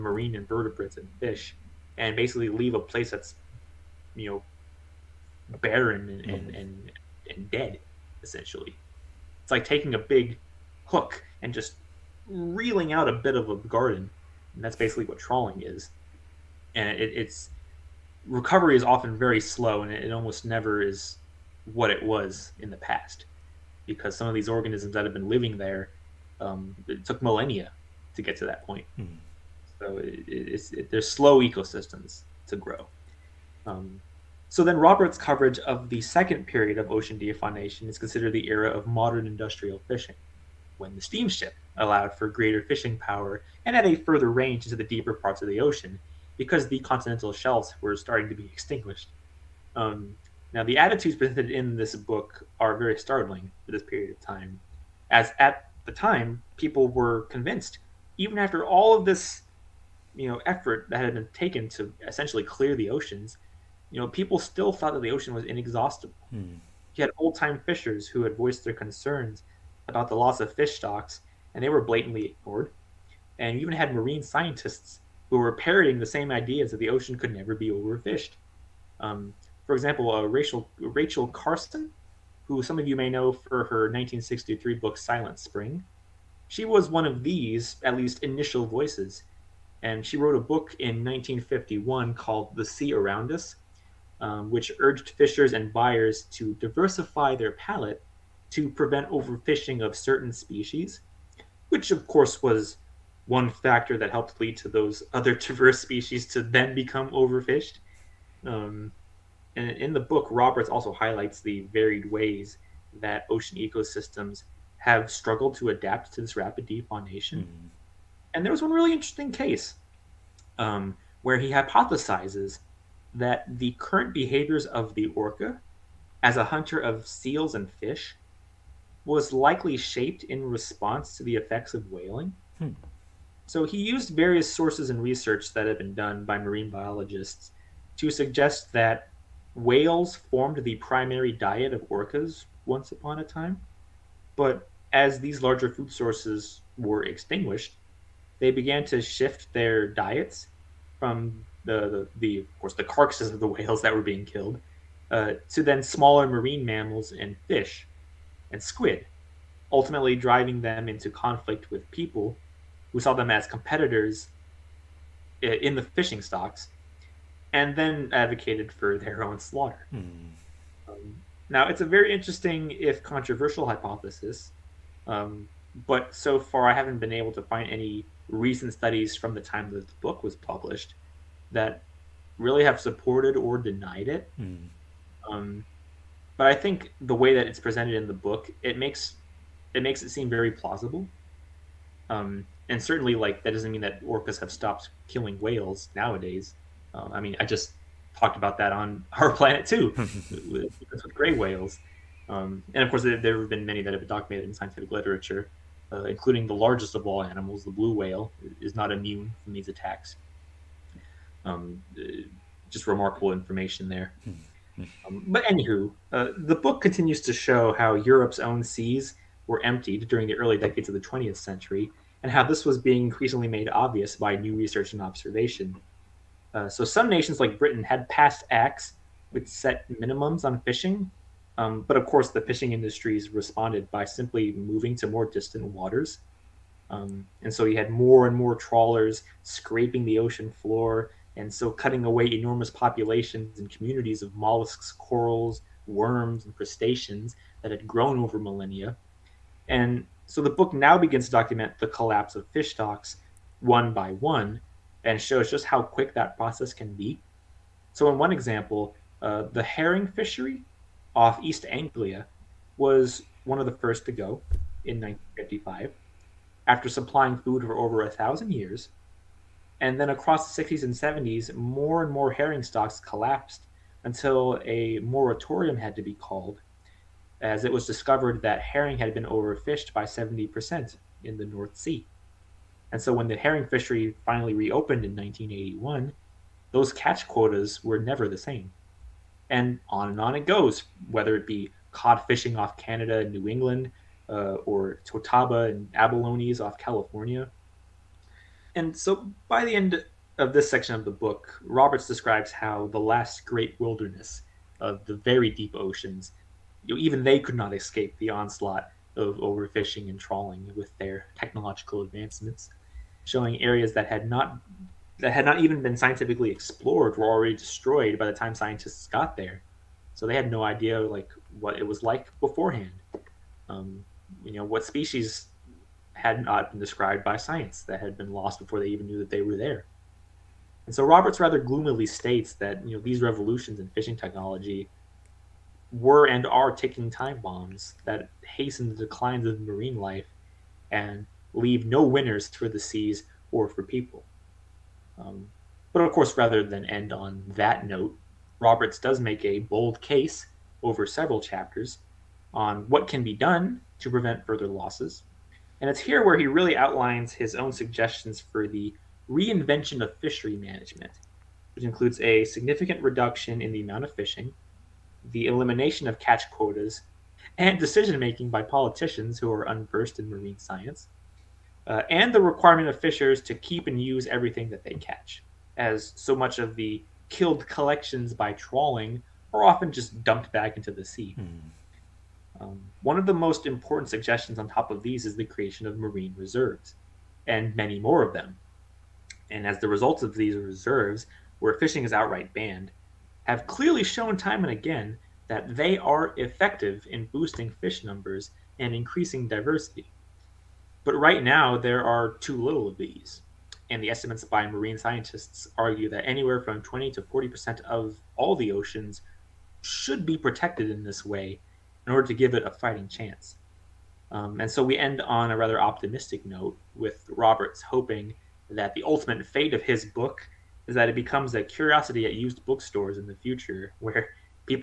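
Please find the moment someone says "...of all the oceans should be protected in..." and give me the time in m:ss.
6:47.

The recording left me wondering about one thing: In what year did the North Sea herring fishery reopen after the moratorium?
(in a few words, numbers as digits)
1981.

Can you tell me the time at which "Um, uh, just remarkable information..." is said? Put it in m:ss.
3:31.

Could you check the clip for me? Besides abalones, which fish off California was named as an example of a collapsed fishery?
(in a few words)
totoaba.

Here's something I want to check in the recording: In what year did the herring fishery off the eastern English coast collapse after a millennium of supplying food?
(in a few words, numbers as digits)
1955.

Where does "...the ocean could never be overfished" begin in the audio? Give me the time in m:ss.
1:16.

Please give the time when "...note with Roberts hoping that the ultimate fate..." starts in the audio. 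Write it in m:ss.
6:56.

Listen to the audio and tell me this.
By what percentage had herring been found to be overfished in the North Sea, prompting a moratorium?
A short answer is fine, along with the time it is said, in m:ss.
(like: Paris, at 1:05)
70%, at 4:40.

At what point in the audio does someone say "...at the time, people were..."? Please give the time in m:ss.
0:55.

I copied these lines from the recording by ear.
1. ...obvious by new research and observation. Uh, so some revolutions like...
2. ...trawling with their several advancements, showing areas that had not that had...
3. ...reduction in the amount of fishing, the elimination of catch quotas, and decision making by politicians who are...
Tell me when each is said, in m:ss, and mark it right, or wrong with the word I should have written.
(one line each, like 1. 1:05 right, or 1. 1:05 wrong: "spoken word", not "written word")
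1. 3:43 wrong: "nations", not "revolutions"
2. 5:10 wrong: "technological", not "several"
3. 6:03 right.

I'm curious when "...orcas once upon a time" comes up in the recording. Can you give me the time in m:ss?
2:21.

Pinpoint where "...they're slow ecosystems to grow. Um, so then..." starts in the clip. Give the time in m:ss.
0:30.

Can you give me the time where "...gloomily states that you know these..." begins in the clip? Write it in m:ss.
5:31.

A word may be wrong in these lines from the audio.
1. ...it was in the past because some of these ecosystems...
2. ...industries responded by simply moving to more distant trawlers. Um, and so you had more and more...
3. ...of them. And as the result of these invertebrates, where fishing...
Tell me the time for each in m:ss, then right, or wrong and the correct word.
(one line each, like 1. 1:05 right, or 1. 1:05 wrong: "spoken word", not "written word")
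1. 0:21 wrong: "organisms", not "ecosystems"
2. 3:52 wrong: "waters", not "trawlers"
3. 6:28 wrong: "reserves", not "invertebrates".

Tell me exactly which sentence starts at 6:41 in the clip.
But right now, there are too little of these.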